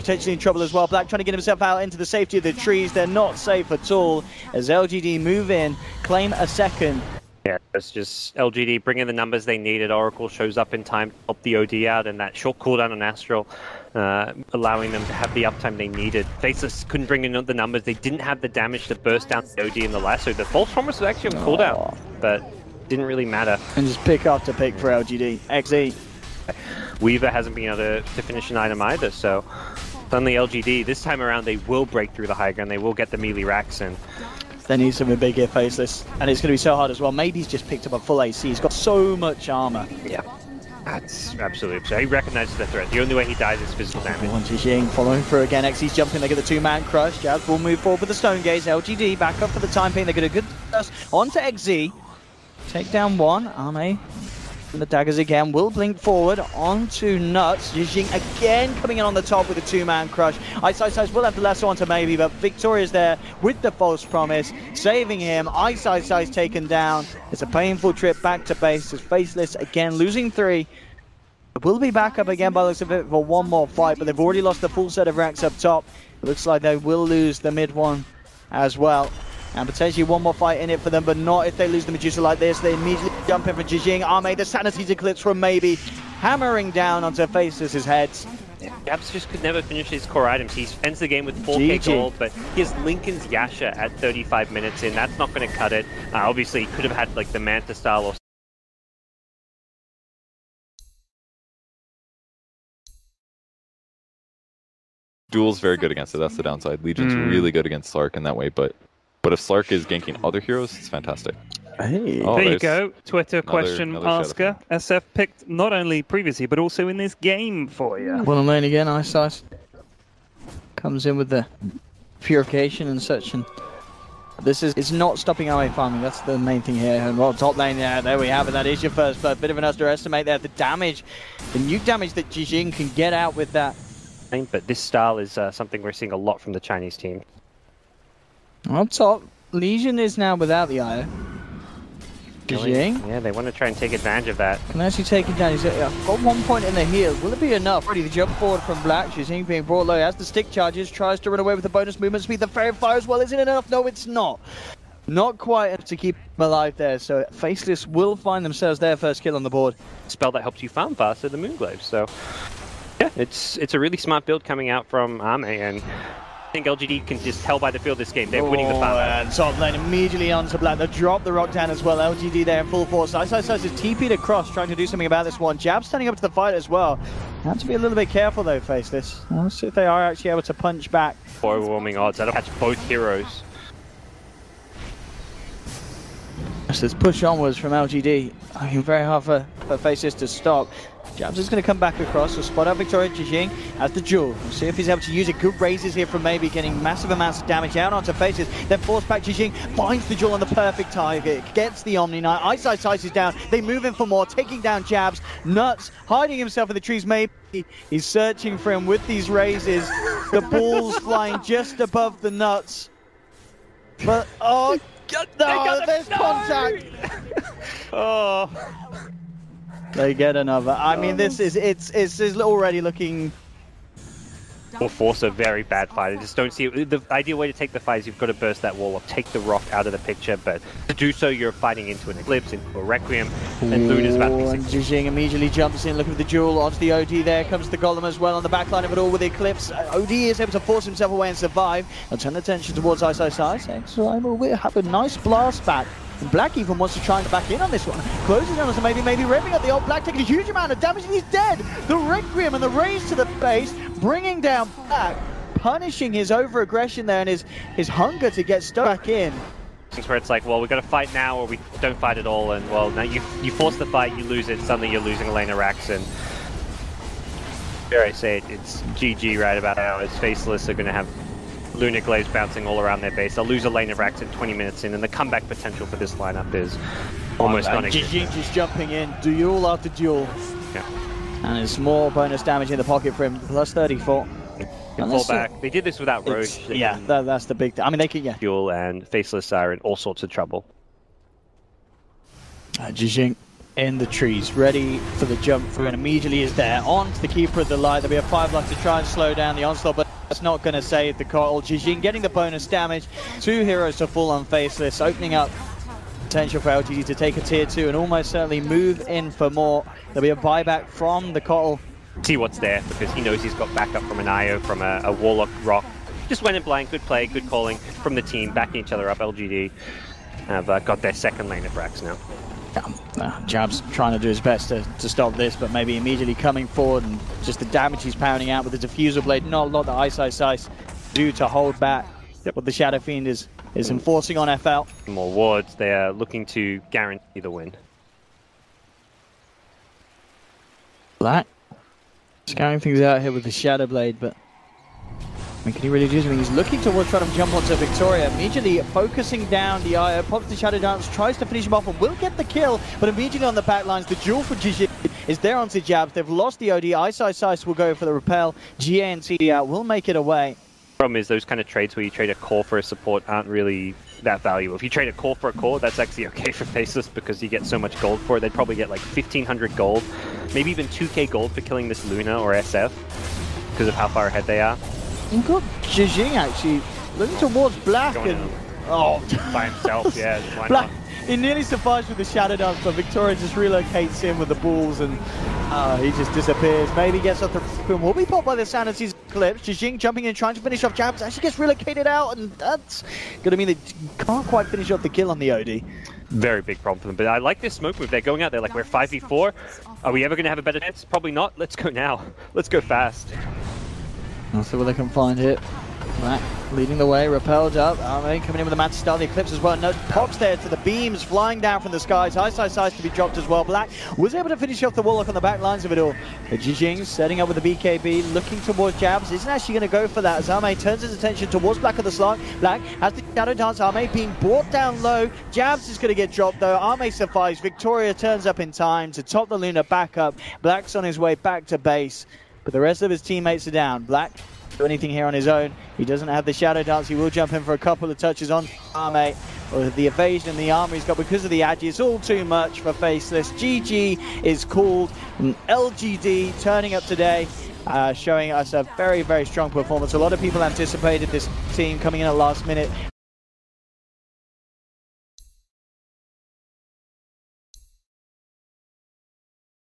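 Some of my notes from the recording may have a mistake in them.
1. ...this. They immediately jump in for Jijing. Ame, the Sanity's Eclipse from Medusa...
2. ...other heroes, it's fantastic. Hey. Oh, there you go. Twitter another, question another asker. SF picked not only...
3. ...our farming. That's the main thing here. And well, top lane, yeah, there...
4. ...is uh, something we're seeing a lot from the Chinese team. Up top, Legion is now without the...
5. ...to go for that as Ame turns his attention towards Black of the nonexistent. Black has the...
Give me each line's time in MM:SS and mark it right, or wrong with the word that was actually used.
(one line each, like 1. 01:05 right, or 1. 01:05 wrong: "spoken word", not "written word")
1. 01:22 wrong: "Maybe", not "Medusa"
2. 01:50 right
3. 02:05 right
4. 02:15 right
5. 06:59 wrong: "slant", not "nonexistent".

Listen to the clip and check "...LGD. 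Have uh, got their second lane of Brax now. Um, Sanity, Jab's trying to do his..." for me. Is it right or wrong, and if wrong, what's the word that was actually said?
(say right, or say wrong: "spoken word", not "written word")
wrong: "Nah", not "Sanity".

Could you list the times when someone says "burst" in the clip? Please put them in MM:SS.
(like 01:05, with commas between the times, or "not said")
00:18, 00:50, 03:48.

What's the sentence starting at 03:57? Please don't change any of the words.
There comes the Golem as well on the backline of it all with the Eclipse.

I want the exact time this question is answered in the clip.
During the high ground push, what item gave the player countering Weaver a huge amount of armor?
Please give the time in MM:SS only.
00:37.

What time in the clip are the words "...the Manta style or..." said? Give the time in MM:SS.
01:37.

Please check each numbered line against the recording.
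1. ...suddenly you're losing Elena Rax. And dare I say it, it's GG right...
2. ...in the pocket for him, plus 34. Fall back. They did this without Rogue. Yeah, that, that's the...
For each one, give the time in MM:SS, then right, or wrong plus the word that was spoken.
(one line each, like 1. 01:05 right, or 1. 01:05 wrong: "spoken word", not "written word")
1. 04:24 right
2. 04:42 right.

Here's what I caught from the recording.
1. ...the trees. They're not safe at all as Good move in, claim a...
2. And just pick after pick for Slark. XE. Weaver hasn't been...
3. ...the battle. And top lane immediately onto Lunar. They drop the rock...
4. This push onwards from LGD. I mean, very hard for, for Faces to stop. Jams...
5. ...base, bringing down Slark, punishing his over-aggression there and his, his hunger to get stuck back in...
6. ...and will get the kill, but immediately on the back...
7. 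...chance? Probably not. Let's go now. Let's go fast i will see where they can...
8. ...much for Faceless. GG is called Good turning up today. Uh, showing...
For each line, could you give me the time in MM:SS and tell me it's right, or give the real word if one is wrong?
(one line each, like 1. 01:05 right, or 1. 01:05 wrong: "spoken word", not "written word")
1. 00:02 wrong: "LGD", not "Good"
2. 00:23 wrong: "LGD", not "Slark"
3. 02:48 wrong: "Black", not "Lunar"
4. 03:06 right
5. 04:13 wrong: "Black", not "Slark"
6. 05:51 right
7. 06:40 right
8. 07:22 wrong: "LGD", not "Good".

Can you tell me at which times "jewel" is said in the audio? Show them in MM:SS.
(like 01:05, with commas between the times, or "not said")
03:13, 03:20, 03:56.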